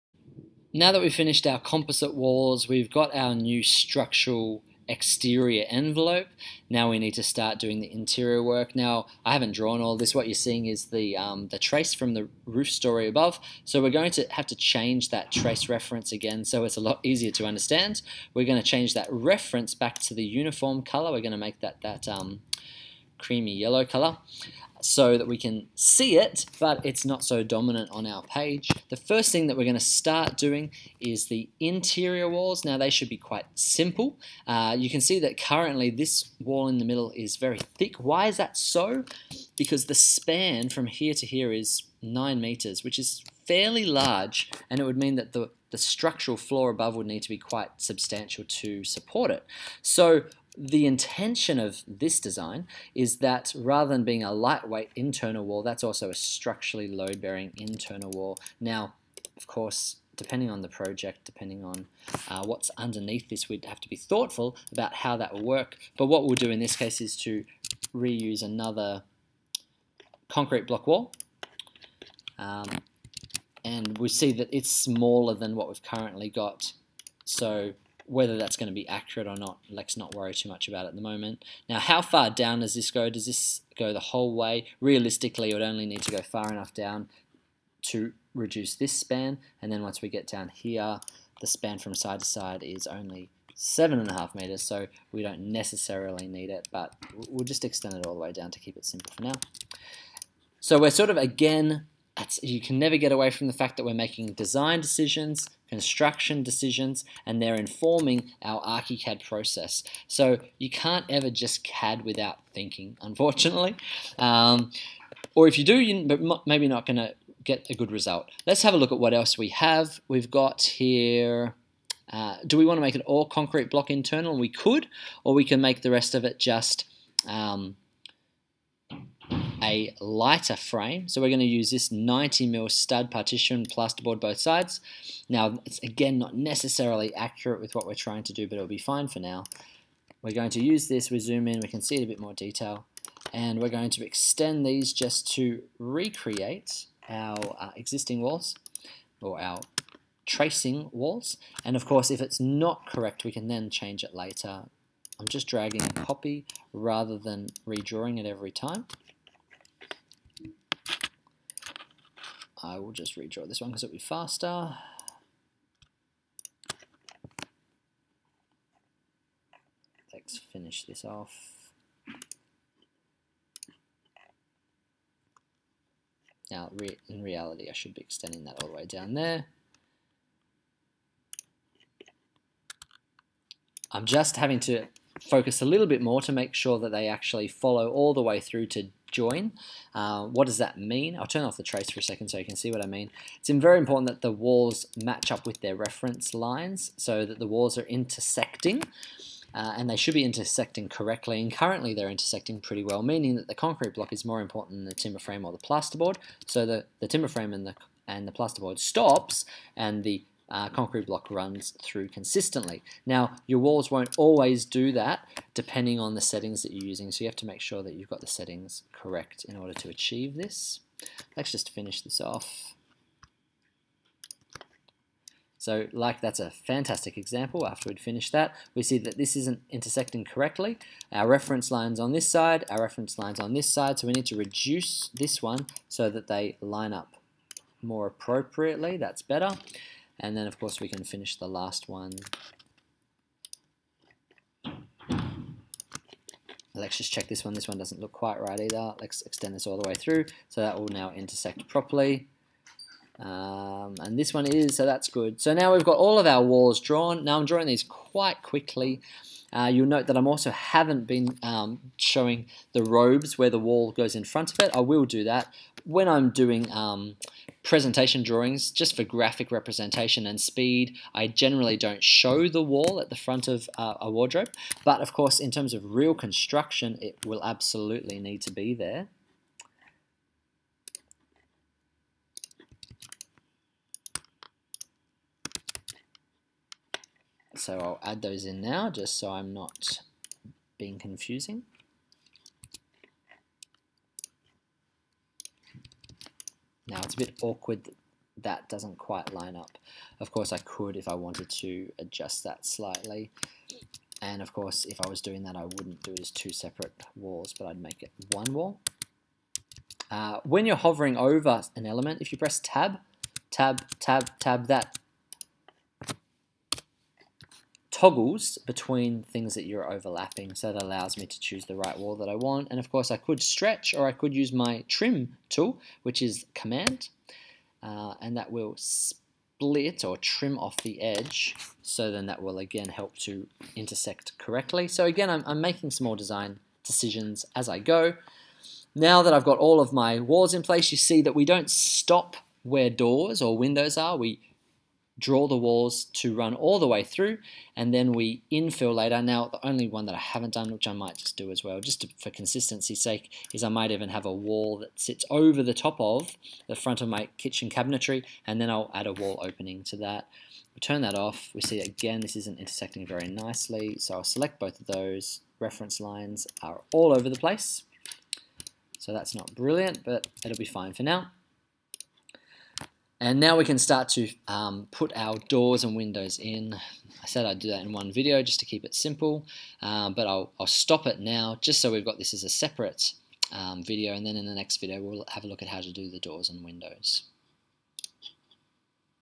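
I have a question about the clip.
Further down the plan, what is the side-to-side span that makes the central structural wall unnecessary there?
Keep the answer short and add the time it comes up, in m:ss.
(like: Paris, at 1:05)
7.5 meters, at 1:33.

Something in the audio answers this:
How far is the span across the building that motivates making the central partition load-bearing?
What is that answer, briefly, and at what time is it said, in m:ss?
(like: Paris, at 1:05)
9 meters, at 0:42.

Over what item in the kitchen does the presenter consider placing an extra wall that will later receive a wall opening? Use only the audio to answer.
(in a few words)
kitchen cabinetry.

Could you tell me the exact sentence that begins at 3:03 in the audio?
I'm just having to focus a little bit more to make sure that they actually follow all the way through to join.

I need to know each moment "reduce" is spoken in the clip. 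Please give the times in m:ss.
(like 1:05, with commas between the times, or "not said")
1:28, 3:54.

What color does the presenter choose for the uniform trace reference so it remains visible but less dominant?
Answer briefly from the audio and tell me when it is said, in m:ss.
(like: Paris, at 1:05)
creamy yellow, at 0:23.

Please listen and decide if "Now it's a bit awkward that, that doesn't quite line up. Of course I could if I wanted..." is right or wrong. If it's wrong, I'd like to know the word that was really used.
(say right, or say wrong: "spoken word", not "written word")
right.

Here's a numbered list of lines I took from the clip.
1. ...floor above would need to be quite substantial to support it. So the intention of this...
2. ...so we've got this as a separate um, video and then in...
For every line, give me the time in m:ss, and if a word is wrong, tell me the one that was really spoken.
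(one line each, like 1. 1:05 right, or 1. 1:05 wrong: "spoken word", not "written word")
1. 0:46 right
2. 6:21 right.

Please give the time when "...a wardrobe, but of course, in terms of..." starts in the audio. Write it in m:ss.
4:33.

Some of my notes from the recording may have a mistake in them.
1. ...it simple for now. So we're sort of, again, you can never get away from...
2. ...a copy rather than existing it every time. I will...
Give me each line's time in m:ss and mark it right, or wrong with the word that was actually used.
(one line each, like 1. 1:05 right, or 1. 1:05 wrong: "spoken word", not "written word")
1. 1:38 right
2. 2:35 wrong: "redrawing", not "existing".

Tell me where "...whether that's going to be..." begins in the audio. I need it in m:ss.
1:18.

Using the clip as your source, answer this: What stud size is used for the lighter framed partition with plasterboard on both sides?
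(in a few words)
90 mil.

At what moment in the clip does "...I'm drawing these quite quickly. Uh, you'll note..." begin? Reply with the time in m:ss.
4:17.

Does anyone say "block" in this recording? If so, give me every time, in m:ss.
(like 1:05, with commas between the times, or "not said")
1:10, 2:03, 3:23, 3:31.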